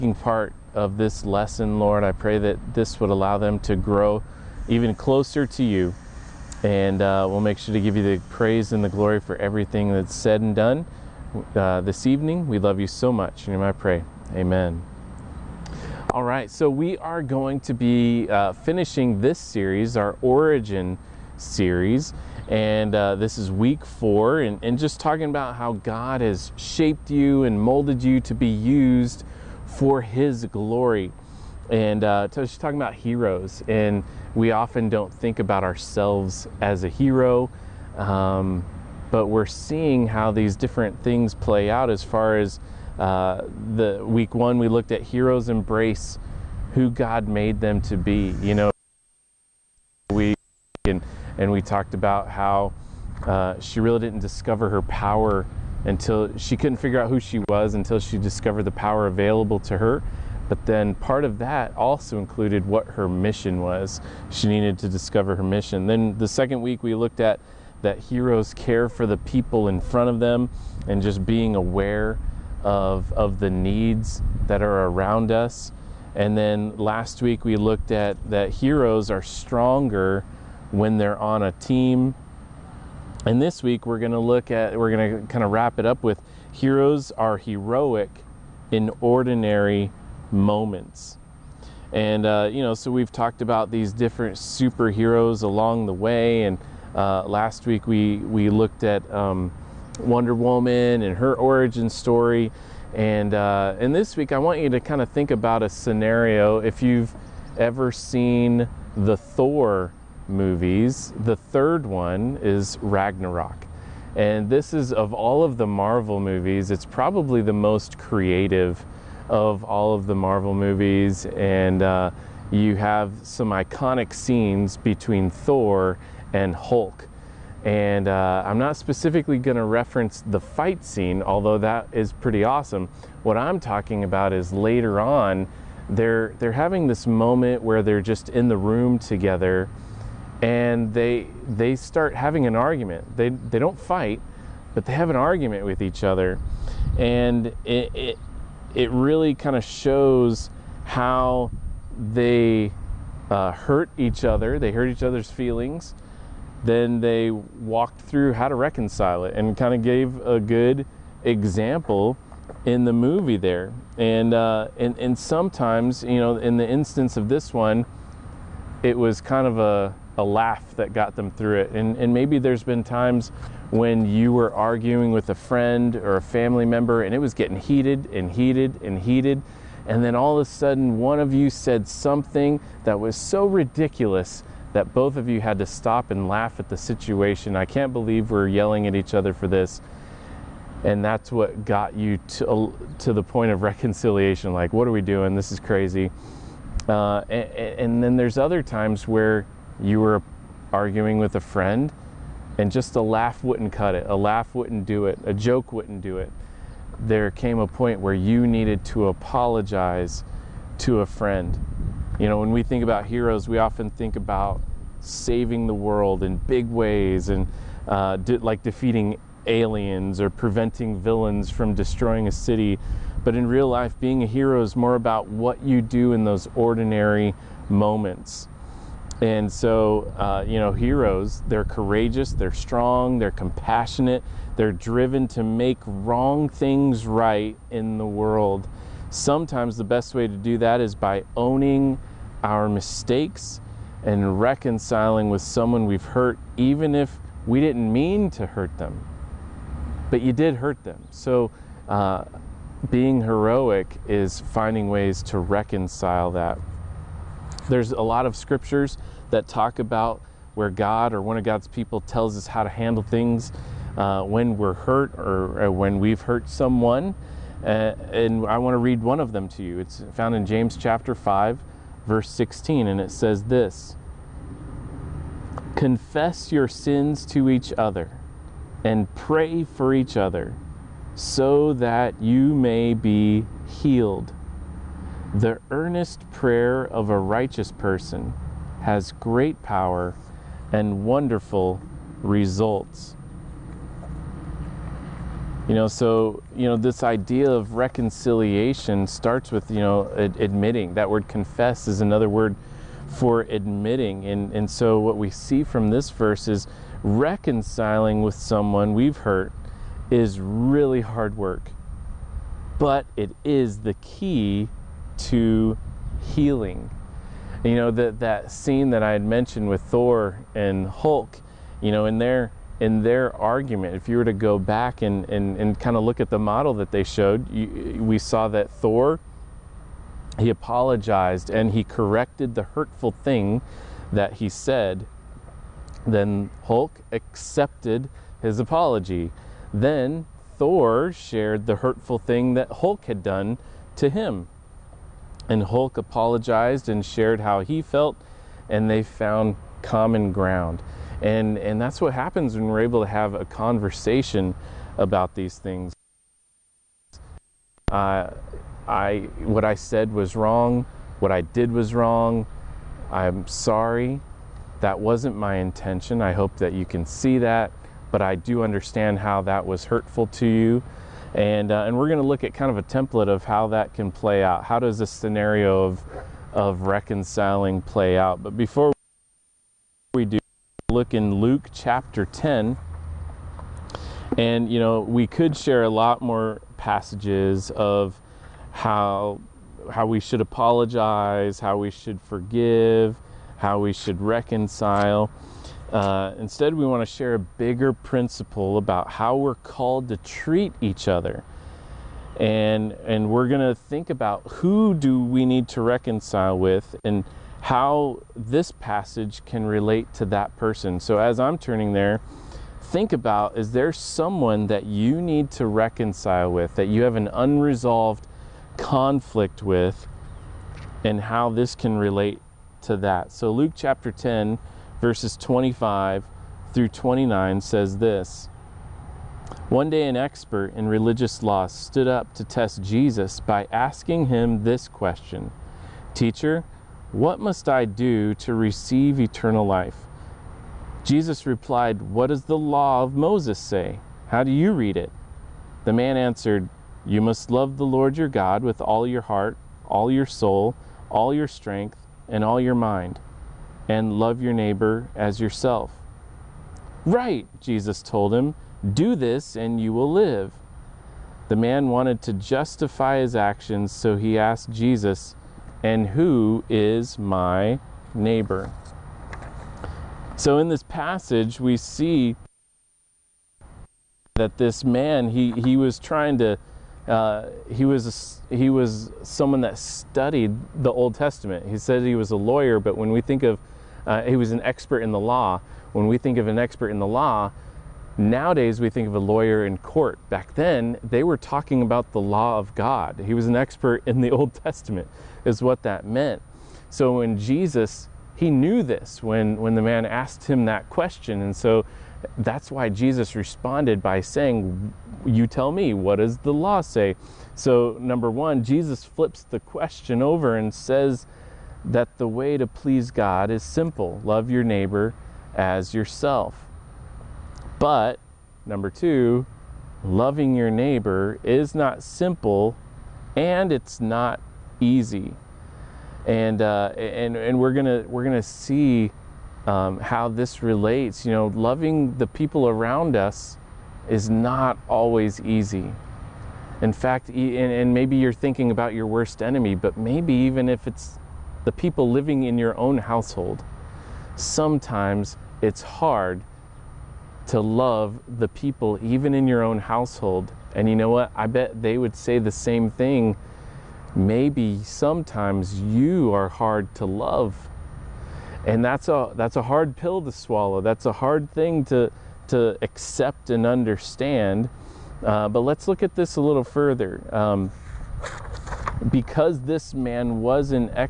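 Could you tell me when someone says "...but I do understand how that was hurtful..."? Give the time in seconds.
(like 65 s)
368 s.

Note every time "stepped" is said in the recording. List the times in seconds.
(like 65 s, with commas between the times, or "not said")
not said.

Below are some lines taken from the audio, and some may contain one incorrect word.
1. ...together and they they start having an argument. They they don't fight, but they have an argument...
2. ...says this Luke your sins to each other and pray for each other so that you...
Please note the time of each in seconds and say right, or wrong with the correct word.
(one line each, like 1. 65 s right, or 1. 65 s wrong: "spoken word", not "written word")
1. 138 s right
2. 273 s wrong: "Confess", not "Luke".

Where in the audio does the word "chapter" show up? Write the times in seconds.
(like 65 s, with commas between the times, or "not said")
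270 s, 381 s, 423 s.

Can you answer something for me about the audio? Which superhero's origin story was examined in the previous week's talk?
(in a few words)
Wonder Woman.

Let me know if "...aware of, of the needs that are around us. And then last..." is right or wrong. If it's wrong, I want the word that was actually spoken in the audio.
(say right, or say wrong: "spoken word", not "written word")
right.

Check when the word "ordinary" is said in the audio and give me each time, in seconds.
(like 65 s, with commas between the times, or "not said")
89 s, 226 s.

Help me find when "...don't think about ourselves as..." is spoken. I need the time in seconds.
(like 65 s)
34 s.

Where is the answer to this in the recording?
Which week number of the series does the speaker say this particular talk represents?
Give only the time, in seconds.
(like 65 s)
23 s.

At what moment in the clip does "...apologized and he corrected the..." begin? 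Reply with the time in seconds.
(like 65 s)
330 s.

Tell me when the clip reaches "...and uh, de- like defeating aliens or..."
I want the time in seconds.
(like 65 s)
217 s.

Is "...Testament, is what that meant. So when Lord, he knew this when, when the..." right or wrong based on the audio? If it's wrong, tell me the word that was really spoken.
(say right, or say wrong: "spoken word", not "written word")
wrong: "Jesus", not "Lord".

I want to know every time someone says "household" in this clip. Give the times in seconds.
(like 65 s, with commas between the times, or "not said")
542 s, 549 s.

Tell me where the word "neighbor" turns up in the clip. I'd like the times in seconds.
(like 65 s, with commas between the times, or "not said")
454 s, 468 s, 514 s, 520 s.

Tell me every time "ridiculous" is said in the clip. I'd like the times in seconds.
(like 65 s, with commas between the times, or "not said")
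183 s.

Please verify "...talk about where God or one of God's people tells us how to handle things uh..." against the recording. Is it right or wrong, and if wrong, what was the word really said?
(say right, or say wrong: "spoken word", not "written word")
right.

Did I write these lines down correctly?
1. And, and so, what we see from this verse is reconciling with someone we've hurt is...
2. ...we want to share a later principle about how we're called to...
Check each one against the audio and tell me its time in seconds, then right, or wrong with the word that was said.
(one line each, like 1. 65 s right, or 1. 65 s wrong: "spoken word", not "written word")
1. 304 s right
2. 396 s wrong: "bigger", not "later".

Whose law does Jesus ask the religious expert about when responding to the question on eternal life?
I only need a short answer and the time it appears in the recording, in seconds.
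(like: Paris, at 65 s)
Moses, at 443 s.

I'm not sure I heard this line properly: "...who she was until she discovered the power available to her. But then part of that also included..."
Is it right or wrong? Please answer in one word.
right.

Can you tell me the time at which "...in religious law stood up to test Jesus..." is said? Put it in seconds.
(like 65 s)
430 s.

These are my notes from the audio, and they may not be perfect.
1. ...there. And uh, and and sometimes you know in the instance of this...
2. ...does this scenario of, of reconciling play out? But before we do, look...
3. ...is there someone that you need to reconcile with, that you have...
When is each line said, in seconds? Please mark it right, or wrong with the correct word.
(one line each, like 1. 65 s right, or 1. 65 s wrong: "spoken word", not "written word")
1. 163 s right
2. 374 s right
3. 413 s right.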